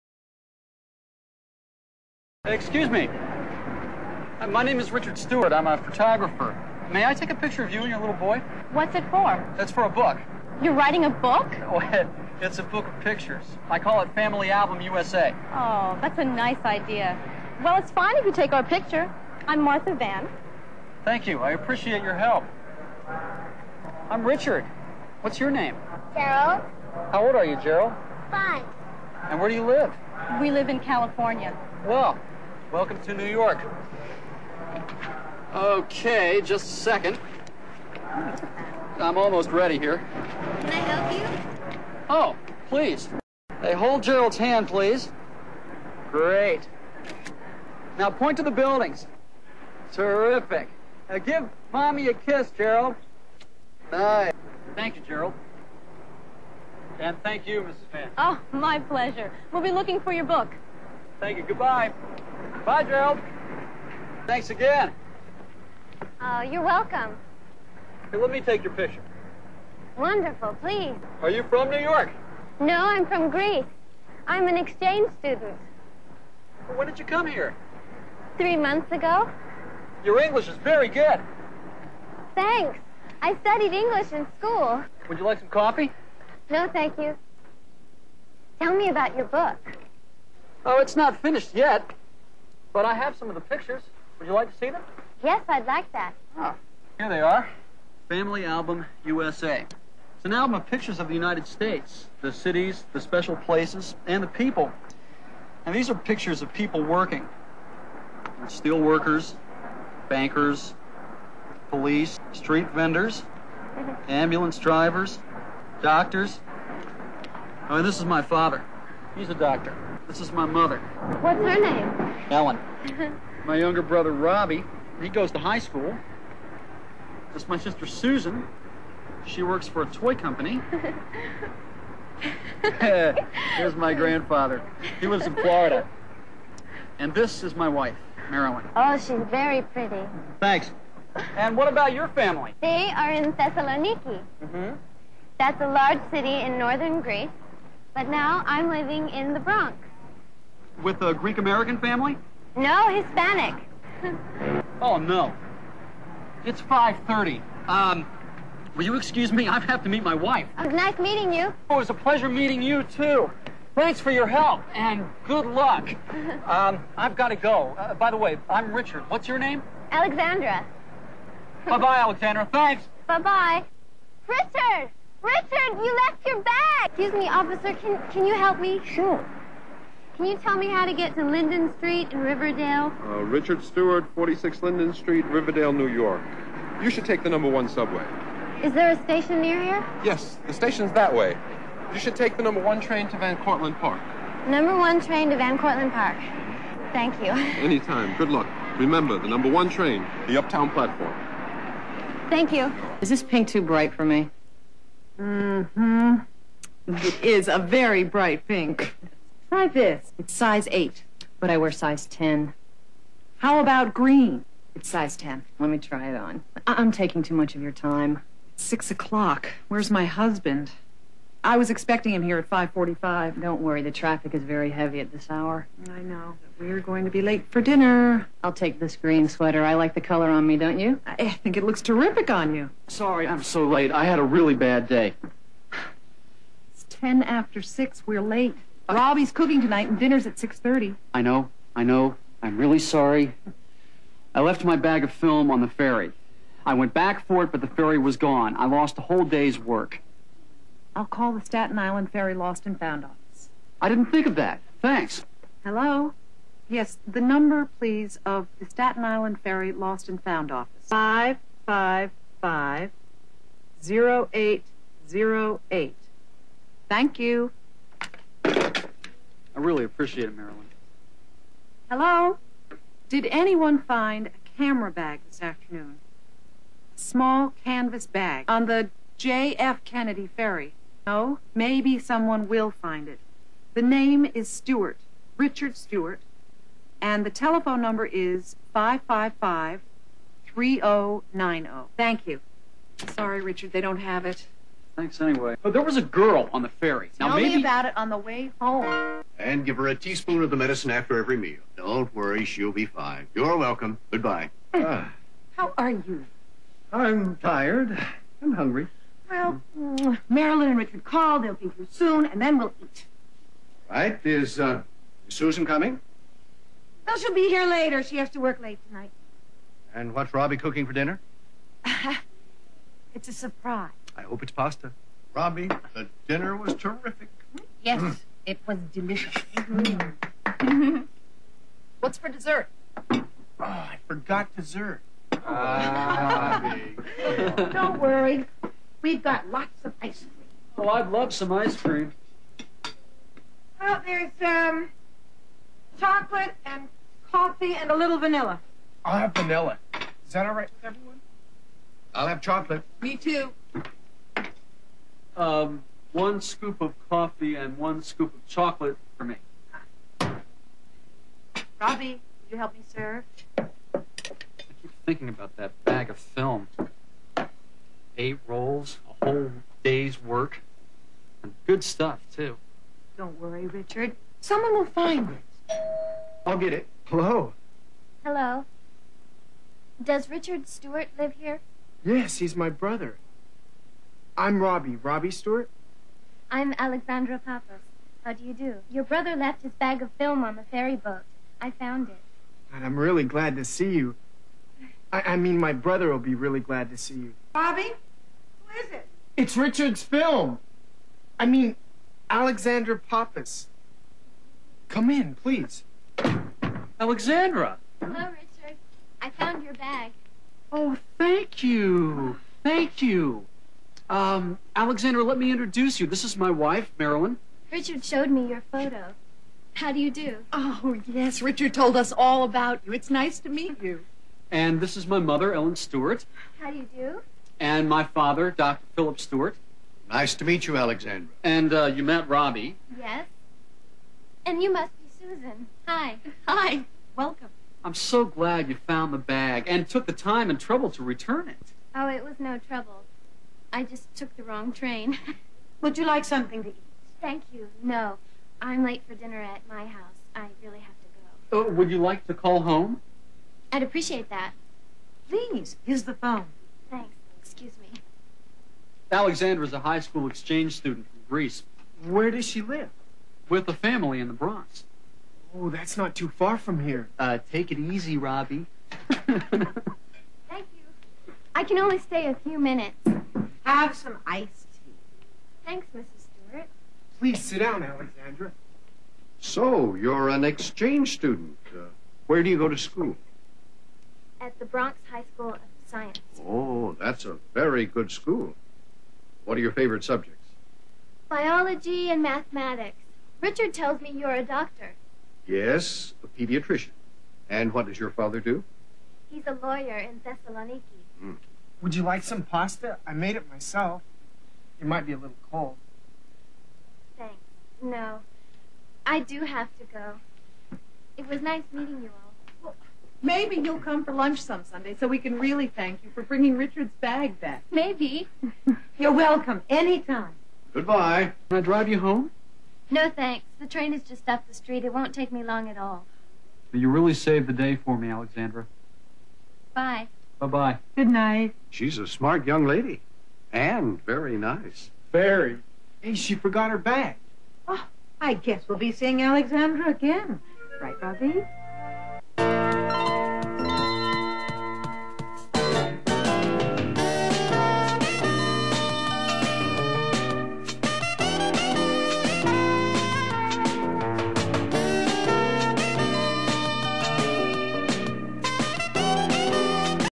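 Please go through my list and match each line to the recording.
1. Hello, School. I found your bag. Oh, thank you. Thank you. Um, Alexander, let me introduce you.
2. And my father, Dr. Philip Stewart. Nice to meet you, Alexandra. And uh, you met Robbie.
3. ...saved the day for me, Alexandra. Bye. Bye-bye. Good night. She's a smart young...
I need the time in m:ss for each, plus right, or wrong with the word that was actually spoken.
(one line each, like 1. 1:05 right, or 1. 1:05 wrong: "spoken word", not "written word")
1. 6:48 wrong: "Richard", not "School"
2. 7:07 right
3. 8:47 right.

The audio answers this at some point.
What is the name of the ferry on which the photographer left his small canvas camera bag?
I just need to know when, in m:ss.
4:39.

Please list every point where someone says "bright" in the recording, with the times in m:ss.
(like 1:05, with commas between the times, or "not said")
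3:23, 3:28.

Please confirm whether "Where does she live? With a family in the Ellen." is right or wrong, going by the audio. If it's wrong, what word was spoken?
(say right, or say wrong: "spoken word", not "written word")
wrong: "Bronx", not "Ellen".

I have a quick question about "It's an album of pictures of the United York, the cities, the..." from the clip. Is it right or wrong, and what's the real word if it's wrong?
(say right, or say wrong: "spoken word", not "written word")
wrong: "States", not "York".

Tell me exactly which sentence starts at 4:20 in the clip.
Five five five zero eight zero eight.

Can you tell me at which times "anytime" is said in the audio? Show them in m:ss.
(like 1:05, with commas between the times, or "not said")
3:17, 8:39.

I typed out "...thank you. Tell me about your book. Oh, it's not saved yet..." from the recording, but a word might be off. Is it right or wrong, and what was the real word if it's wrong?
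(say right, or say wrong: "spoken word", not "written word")
wrong: "finished", not "saved".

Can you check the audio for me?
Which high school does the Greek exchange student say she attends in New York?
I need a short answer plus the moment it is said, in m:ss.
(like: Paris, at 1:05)
Bronx High School of Science, at 8:04.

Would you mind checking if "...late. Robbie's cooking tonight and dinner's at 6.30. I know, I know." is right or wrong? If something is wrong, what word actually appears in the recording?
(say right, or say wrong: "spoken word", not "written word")
right.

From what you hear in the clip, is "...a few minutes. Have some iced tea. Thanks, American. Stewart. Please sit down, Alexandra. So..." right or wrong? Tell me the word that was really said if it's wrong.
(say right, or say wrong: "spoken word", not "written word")
wrong: "Mrs", not "American".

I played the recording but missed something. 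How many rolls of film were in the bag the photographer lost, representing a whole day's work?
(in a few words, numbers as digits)
8.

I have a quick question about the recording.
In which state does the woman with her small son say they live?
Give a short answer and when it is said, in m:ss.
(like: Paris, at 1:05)
California, at 0:30.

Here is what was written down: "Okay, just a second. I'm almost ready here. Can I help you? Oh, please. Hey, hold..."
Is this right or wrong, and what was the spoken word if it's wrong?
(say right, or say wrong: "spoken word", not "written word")
right.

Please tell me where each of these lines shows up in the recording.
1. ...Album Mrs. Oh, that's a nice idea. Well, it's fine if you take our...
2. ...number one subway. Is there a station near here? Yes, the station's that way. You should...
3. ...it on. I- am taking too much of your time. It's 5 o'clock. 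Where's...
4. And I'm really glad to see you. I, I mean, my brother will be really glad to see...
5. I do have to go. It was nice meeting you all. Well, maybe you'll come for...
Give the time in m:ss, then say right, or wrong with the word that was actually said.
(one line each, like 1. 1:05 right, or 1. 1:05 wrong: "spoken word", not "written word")
1. 0:14 wrong: "USA", not "Mrs"
2. 3:07 right
3. 3:36 wrong: "6", not "5"
4. 6:32 right
5. 8:29 right.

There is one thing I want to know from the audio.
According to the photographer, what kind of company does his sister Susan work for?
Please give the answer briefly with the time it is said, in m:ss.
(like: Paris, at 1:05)
A toy company, at 2:09.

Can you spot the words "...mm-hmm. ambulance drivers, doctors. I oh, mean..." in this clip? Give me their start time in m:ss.
1:53.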